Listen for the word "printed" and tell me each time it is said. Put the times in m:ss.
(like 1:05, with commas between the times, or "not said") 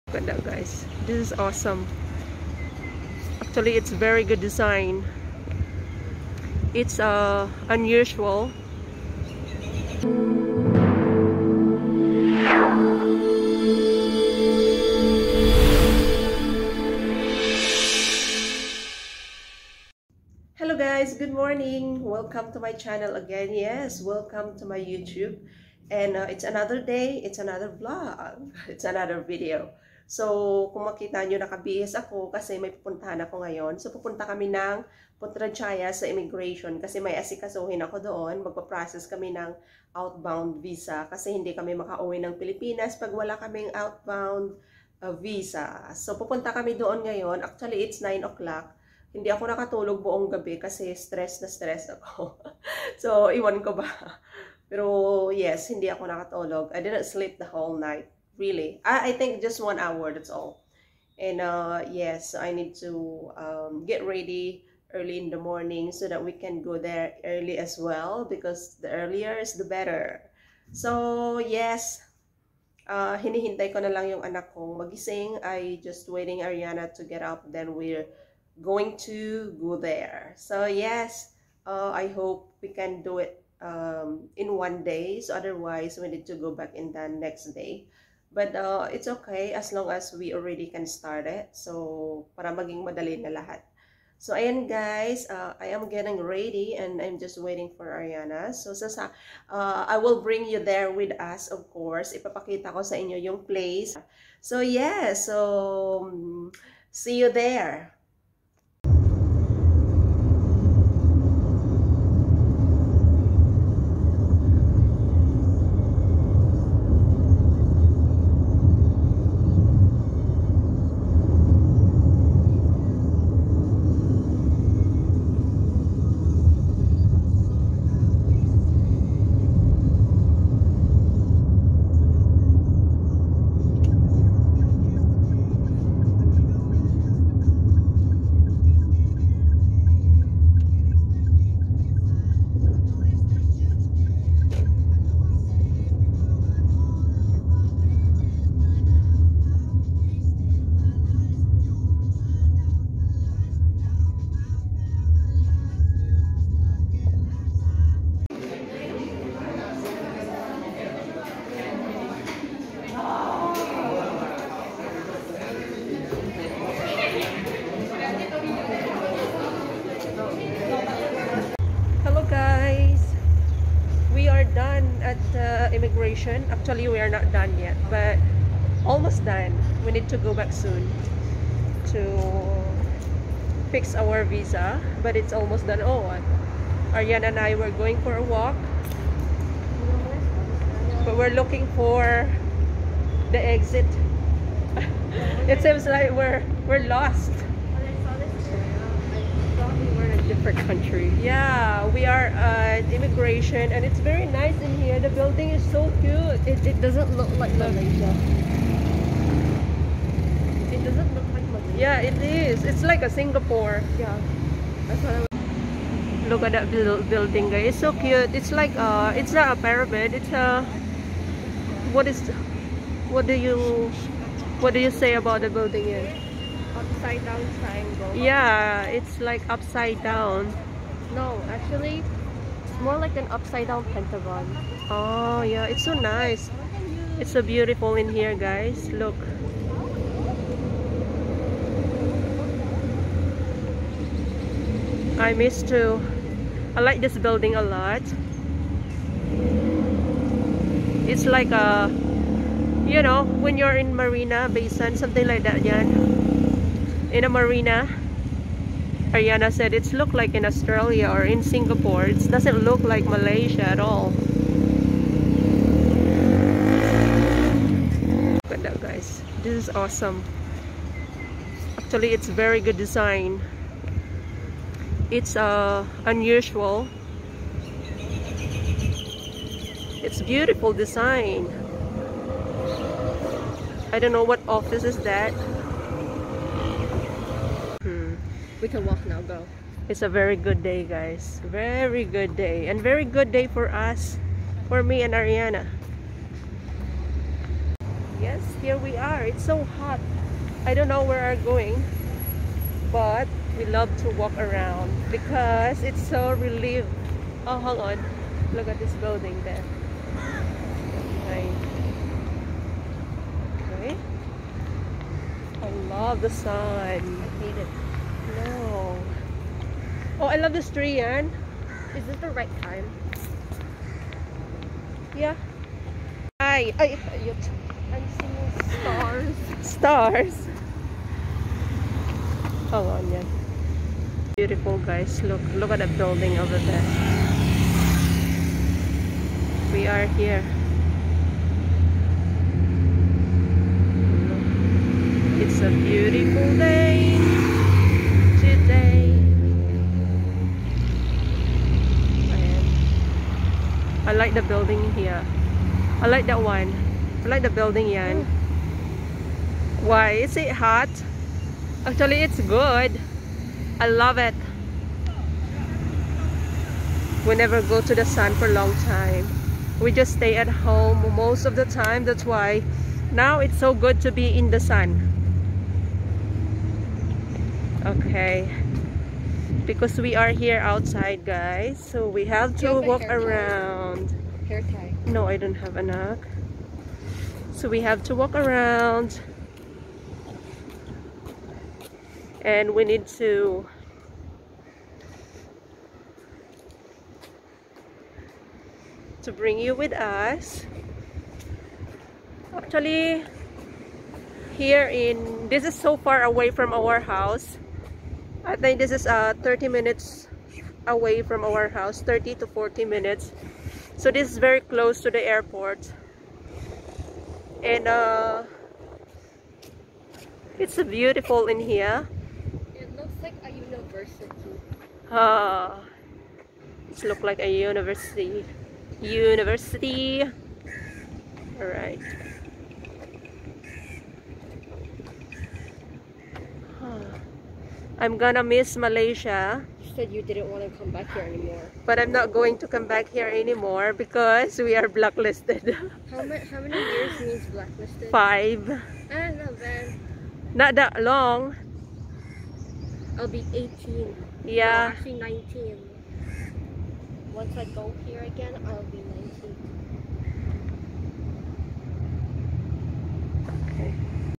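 not said.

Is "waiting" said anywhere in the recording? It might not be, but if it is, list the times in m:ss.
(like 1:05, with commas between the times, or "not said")
1:16, 1:37.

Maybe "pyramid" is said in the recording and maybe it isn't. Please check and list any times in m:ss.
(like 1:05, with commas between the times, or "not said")
3:39.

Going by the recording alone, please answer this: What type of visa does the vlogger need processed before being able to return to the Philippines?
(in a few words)
Outbound visa.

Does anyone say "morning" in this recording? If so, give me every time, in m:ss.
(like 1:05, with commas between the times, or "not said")
0:21, 1:05.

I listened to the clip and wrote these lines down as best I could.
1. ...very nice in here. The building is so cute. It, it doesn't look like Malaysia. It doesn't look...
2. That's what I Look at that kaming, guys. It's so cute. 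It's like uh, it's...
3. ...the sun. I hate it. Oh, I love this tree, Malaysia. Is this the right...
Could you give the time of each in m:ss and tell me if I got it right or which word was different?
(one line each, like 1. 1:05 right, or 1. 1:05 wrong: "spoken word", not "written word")
1. 3:23 right
2. 3:34 wrong: "building", not "kaming"
3. 5:16 wrong: "Anne", not "Malaysia".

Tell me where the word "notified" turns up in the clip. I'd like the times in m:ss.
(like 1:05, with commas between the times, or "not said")
not said.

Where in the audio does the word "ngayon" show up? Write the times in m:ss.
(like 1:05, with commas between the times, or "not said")
0:33, 0:47.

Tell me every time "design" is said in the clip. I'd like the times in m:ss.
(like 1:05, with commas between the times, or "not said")
0:04, 4:32, 4:40.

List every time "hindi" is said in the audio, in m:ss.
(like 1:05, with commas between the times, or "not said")
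0:41, 0:49, 0:55.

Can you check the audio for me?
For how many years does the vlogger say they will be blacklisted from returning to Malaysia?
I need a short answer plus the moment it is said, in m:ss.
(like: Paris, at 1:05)
5, at 7:28.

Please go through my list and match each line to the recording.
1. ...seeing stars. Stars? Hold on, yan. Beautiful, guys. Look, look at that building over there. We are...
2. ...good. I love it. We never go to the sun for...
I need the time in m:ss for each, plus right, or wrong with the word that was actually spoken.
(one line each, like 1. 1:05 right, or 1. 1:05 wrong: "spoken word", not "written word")
1. 5:28 right
2. 6:02 right.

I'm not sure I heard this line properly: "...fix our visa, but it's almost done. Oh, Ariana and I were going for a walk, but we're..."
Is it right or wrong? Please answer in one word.
right.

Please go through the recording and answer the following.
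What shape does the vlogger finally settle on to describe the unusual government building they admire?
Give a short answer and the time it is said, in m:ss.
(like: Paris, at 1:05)
Upside down pentagon, at 3:53.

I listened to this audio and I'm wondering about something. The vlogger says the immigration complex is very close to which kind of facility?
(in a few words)
Airport.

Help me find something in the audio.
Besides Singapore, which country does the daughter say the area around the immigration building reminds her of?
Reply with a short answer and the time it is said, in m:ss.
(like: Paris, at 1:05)
Australia, at 4:20.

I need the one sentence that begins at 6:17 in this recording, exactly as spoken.
Okay because we are here outside guys so we have to have walk around tie.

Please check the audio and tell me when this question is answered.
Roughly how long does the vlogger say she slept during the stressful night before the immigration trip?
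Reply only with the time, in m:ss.
0:59.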